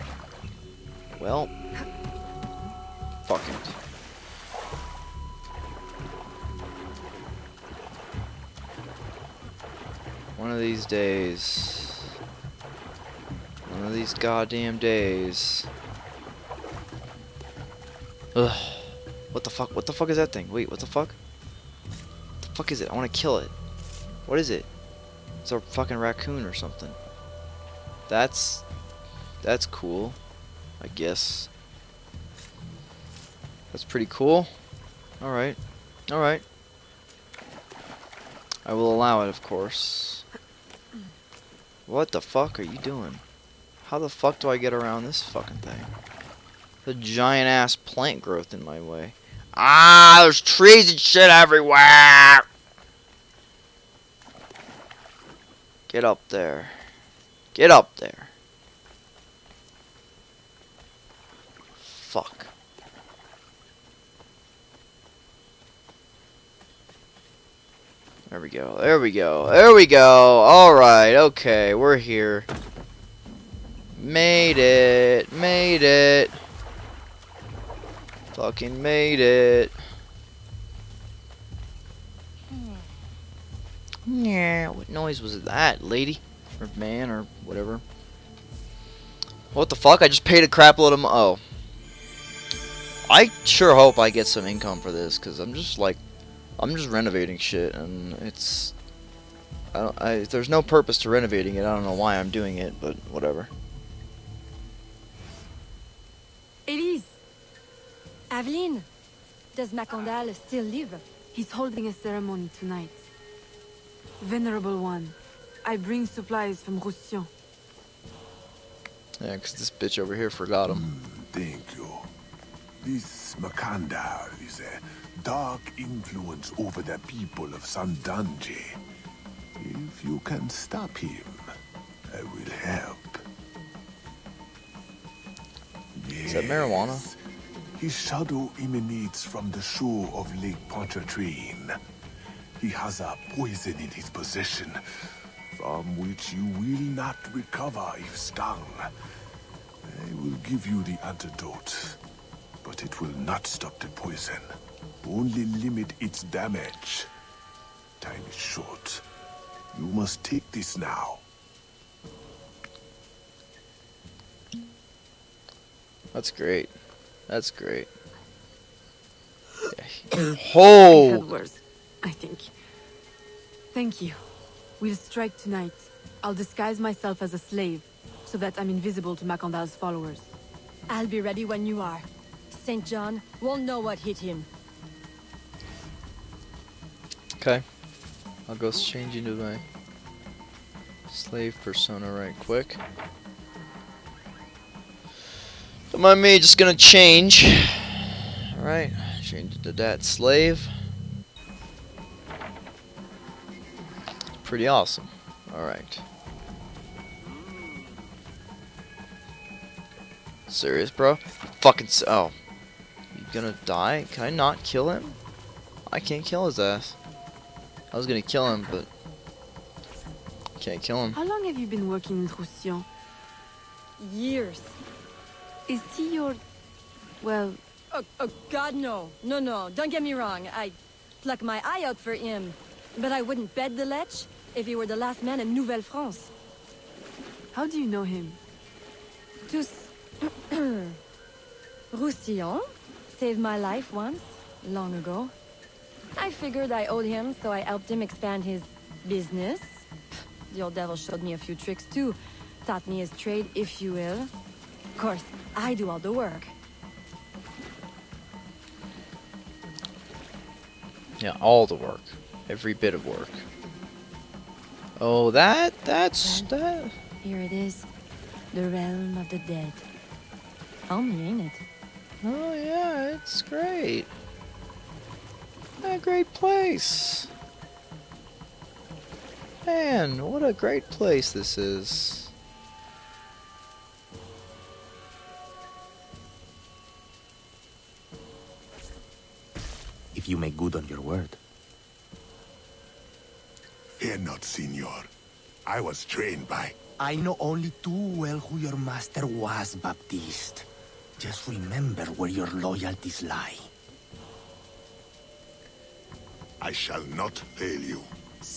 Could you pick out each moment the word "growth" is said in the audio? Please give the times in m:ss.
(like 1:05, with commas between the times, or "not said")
0:48.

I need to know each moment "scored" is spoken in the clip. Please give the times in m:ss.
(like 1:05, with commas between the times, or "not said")
not said.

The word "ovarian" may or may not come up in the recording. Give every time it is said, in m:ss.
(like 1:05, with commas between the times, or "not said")
not said.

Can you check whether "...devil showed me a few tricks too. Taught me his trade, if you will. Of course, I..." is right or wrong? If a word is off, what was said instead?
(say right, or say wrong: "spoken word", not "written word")
right.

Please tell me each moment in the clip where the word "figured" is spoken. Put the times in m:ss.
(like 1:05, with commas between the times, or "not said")
4:06.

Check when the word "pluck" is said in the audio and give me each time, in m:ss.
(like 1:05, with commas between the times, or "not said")
3:51.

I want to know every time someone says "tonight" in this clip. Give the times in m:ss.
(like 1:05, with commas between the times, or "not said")
1:52, 2:55.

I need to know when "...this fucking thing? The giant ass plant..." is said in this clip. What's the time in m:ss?
0:45.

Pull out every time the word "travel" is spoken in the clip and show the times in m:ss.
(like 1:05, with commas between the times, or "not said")
not said.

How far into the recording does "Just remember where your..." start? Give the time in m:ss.
5:01.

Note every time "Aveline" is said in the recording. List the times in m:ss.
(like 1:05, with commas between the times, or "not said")
1:48.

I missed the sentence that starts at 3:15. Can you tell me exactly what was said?
Don't mind me, just gonna change.